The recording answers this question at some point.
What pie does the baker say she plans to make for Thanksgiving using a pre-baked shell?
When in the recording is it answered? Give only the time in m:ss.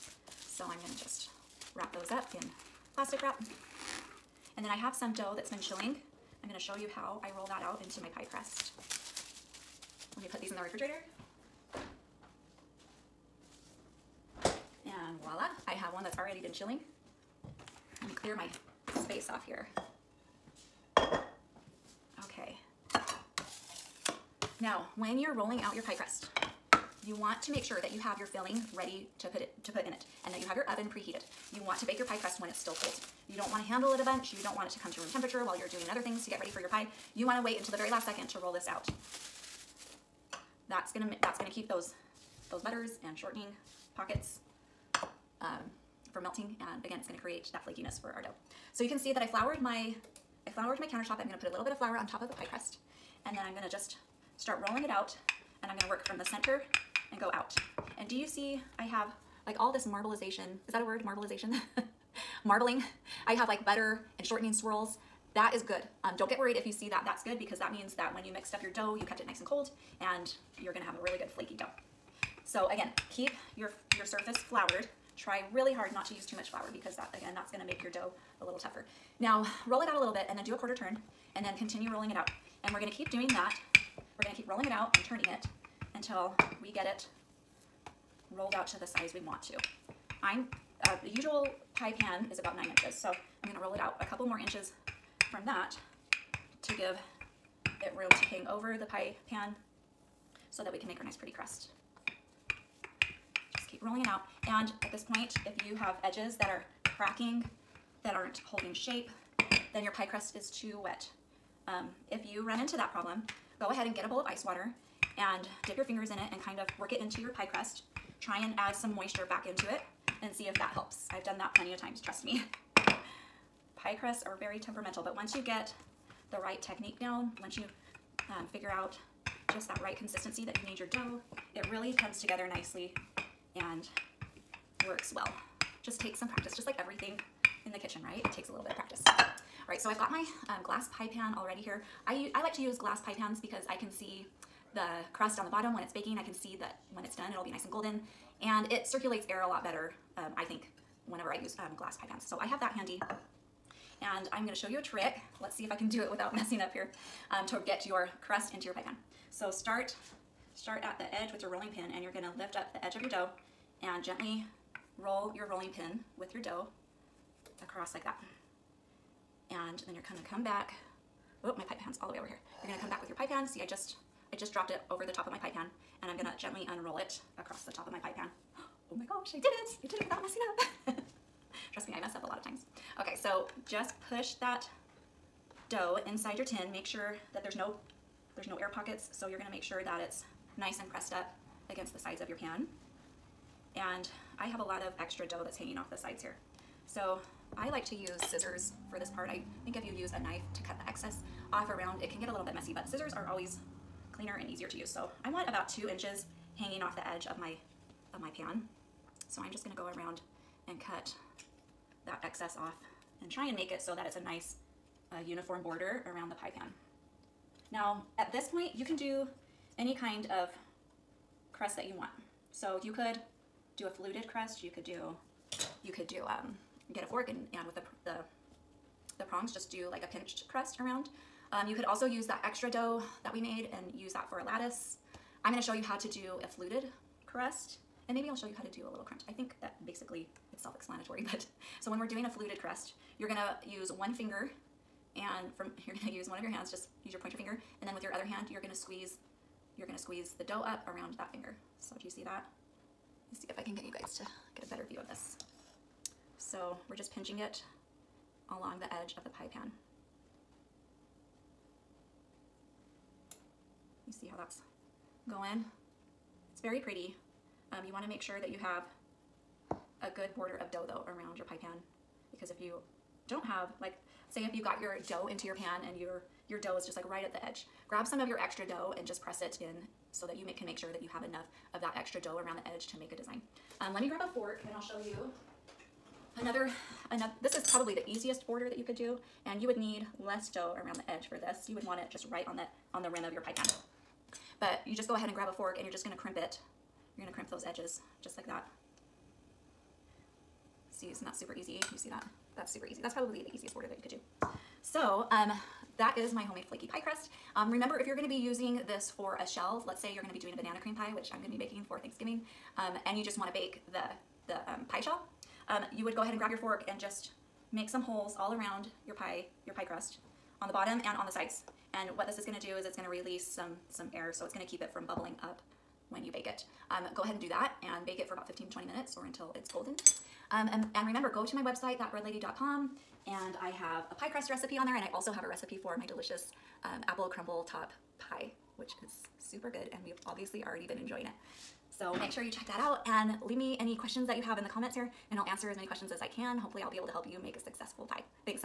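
5:10.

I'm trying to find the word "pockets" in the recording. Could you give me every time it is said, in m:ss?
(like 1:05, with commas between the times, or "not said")
0:43, 3:08.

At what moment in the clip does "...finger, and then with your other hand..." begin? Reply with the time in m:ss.
4:07.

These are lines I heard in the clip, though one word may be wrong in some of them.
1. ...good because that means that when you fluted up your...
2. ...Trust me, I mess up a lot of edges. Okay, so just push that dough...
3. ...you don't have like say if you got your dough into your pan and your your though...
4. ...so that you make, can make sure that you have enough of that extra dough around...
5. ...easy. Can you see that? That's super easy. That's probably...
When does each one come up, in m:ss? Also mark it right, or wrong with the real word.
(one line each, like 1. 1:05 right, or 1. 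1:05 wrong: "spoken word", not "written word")
1. 1:07 wrong: "mixed", not "fluted"
2. 3:01 wrong: "times", not "edges"
3. 4:32 wrong: "dough", not "though"
4. 4:40 right
5. 5:01 right.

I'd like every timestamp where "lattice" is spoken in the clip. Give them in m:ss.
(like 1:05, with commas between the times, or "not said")
3:54.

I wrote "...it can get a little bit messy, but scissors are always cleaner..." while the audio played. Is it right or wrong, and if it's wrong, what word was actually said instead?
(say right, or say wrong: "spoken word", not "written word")
right.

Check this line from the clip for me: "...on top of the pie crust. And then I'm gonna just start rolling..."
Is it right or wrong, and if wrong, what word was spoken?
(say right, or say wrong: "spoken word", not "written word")
right.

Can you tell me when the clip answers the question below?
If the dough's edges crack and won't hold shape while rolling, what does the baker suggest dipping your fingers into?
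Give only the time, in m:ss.
1:54.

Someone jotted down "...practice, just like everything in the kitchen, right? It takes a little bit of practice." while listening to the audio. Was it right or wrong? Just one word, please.
right.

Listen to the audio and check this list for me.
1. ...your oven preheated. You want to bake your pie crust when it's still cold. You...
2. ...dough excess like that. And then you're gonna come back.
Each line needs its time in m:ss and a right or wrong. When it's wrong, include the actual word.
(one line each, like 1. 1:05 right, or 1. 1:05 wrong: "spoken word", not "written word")
1. 0:30 right
2. 2:46 wrong: "across", not "excess".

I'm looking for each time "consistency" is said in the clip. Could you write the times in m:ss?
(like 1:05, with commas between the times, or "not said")
2:09.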